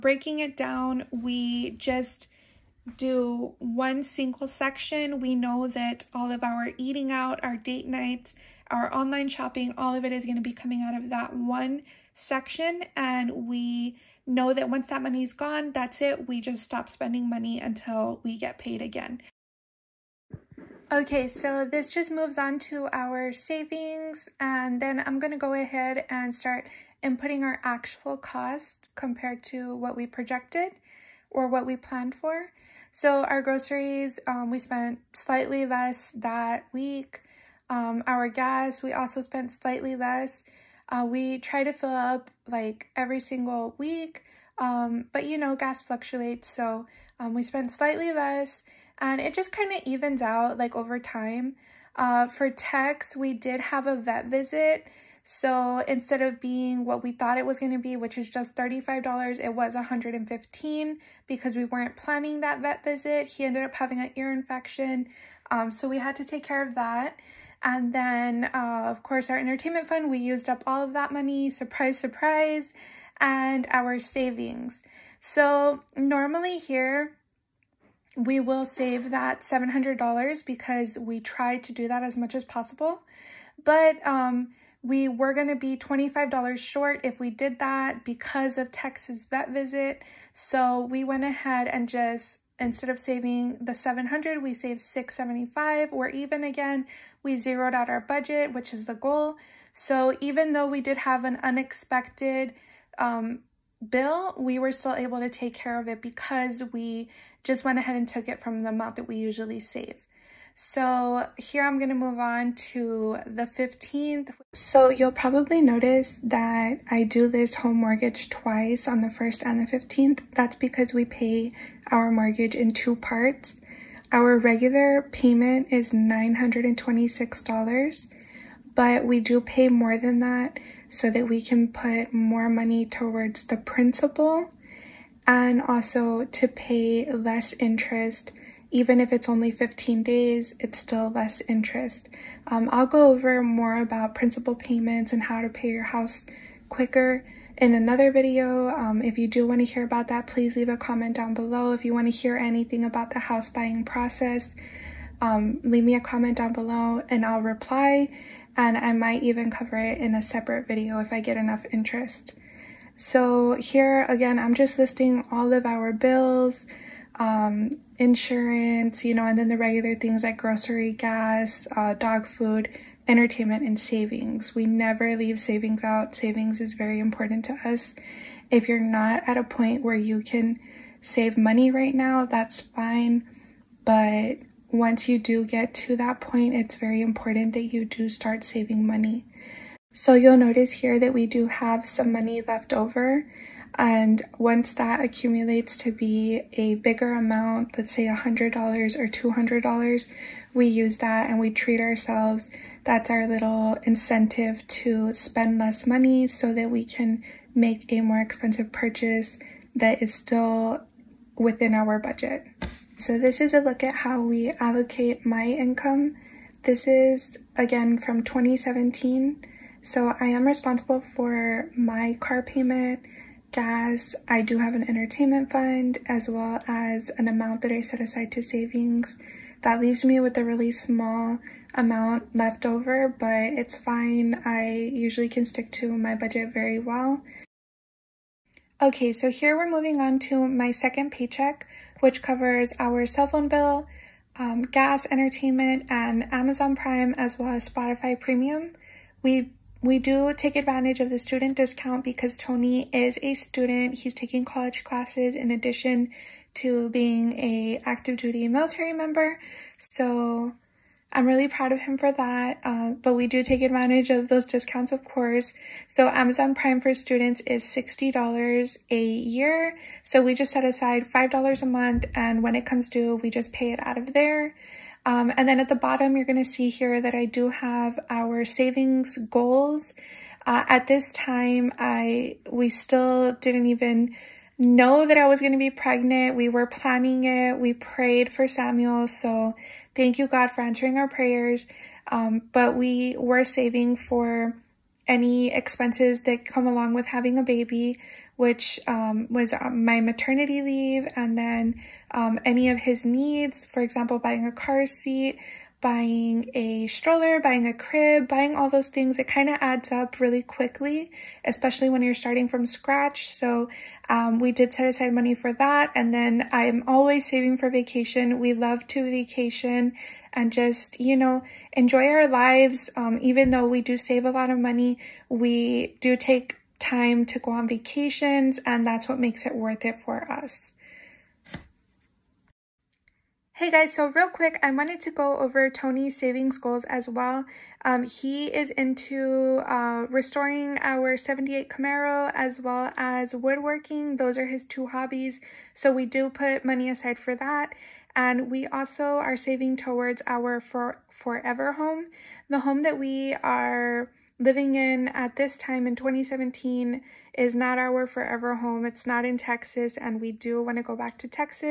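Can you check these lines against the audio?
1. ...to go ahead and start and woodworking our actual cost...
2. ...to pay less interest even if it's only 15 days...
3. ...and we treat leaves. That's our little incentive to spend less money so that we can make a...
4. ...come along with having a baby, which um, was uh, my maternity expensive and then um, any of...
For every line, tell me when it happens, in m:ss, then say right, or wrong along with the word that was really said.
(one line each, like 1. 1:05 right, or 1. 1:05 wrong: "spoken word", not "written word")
1. 0:25 wrong: "putting", not "woodworking"
2. 2:16 right
3. 3:21 wrong: "ourselves", not "leaves"
4. 4:56 wrong: "leave", not "expensive".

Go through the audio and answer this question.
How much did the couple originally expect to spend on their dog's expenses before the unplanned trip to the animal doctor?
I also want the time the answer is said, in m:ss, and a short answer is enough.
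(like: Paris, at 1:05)
$35, at 0:58.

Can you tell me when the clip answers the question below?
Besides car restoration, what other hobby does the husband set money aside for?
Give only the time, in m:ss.
5:43.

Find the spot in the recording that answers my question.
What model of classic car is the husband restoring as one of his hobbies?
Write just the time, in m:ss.
5:41.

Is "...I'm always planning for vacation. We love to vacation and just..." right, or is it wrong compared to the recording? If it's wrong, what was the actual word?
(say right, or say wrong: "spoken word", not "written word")
wrong: "saving", not "planning".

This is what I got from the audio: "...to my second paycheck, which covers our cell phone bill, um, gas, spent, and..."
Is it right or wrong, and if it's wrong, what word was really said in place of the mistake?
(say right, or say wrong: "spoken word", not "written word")
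wrong: "entertainment", not "spent".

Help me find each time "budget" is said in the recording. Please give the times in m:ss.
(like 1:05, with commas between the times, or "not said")
1:38, 3:31, 3:56.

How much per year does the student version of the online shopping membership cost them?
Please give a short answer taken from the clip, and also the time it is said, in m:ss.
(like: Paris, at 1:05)
$60, at 4:27.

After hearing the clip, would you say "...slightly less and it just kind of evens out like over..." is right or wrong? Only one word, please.
right.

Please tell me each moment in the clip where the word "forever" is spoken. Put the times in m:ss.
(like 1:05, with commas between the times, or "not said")
5:51, 5:58.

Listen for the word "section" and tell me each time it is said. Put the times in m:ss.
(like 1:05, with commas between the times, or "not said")
0:04, 0:12.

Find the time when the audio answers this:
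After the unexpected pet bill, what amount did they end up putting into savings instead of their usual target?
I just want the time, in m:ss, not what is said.
1:34.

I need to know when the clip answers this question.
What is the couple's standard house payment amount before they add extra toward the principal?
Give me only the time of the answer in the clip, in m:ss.
2:05.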